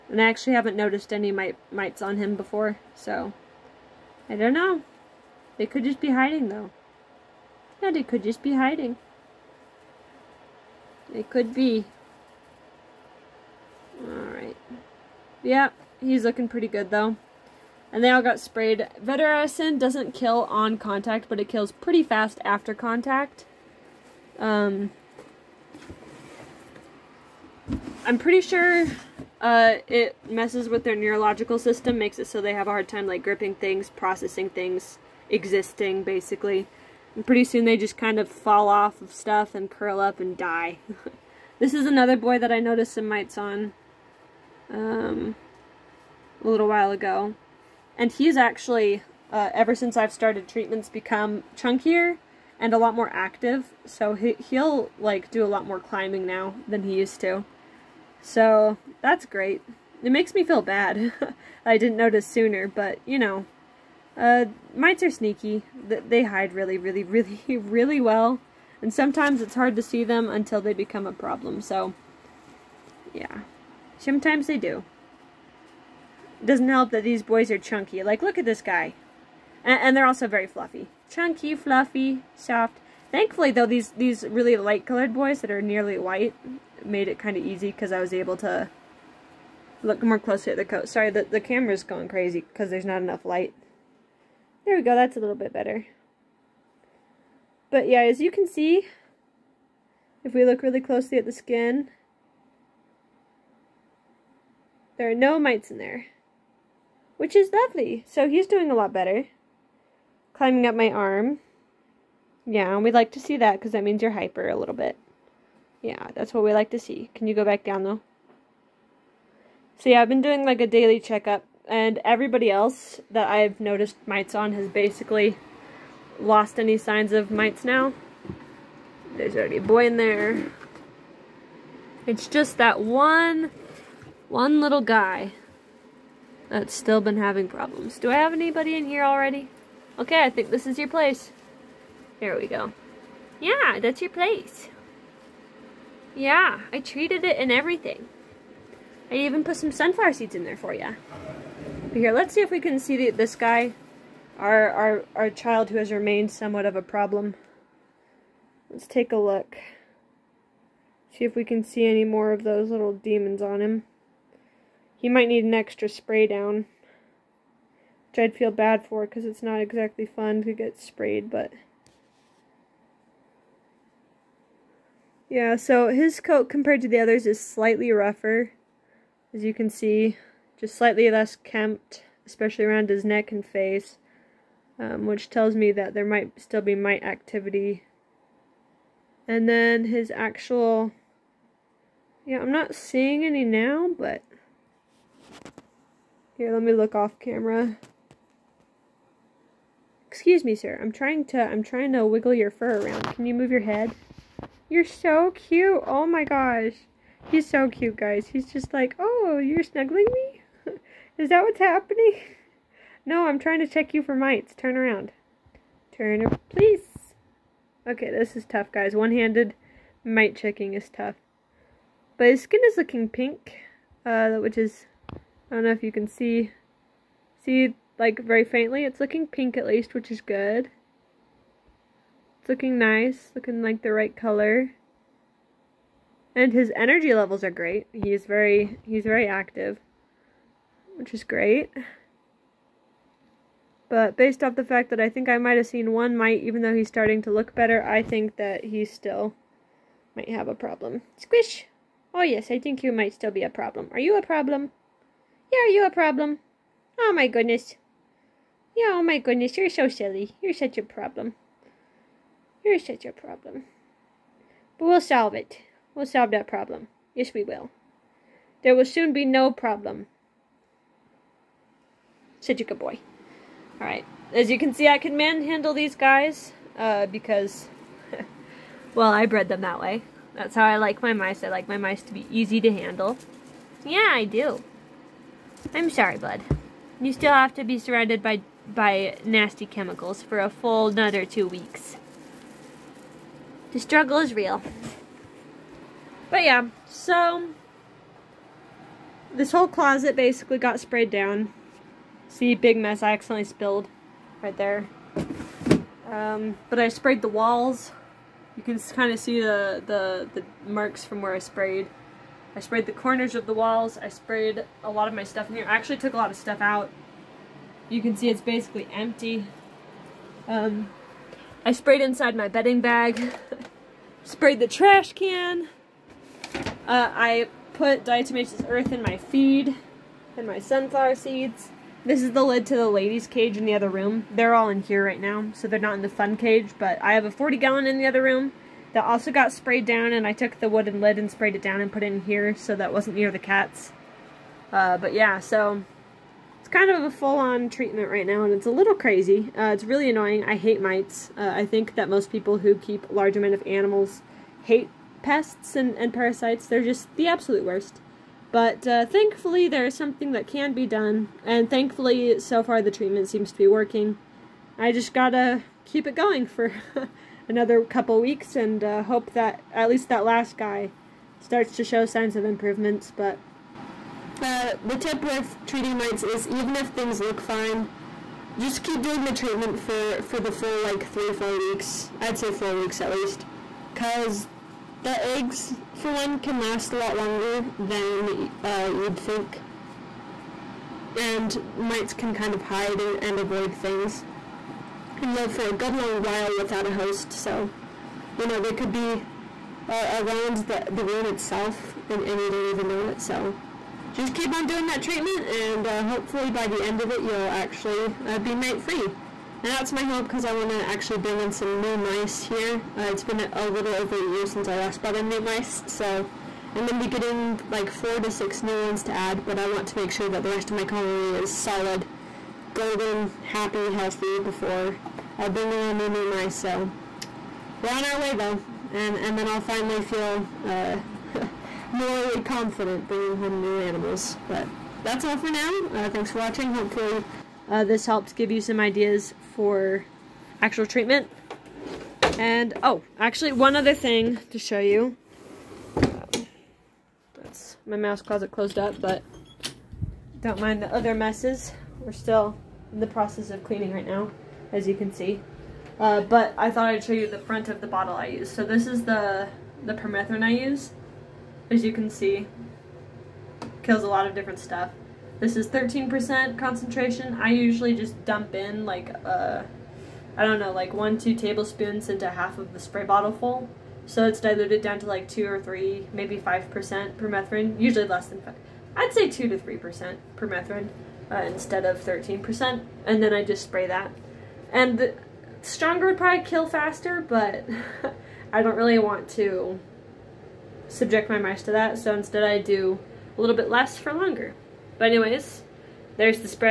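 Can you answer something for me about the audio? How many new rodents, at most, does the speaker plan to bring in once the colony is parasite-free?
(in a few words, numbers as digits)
6.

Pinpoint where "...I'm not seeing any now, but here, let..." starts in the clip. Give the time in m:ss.
3:12.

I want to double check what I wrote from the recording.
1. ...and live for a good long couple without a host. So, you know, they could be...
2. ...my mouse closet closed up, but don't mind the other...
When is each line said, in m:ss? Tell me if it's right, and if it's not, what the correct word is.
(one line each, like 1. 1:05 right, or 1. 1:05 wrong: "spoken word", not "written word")
1. 6:35 wrong: "while", not "couple"
2. 7:27 right.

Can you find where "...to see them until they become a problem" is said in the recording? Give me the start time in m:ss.
1:09.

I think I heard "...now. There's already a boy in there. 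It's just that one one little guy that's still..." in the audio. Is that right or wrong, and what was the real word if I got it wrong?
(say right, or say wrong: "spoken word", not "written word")
right.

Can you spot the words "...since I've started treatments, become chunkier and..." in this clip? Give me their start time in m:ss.
0:49.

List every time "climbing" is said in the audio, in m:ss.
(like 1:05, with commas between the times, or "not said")
0:55, 1:50.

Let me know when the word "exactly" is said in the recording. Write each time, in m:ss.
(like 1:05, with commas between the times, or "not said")
2:49.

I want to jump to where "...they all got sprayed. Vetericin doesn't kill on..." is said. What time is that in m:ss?
0:18.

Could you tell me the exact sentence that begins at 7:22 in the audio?
And oh, actually one other thing to show you.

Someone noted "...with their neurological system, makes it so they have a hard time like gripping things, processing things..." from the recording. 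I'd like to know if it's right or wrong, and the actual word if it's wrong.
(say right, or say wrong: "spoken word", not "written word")
right.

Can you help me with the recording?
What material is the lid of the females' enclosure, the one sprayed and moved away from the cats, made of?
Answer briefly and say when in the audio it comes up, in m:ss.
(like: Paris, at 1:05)
wooden, at 5:40.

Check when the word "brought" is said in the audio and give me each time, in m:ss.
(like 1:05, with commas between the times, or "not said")
6:54.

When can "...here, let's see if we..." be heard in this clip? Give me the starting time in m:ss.
2:31.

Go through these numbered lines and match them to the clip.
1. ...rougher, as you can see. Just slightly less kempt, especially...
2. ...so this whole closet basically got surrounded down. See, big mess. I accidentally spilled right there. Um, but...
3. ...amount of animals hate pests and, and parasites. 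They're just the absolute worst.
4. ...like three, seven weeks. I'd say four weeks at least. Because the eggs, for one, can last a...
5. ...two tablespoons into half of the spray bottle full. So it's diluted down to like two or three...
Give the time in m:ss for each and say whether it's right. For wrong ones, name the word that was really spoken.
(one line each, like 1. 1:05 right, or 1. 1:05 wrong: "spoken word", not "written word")
1. 2:57 right
2. 4:56 wrong: "sprayed", not "surrounded"
3. 5:53 right
4. 6:20 wrong: "four", not "seven"
5. 7:51 right.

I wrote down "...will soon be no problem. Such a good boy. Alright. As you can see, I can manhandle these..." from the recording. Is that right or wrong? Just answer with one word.
right.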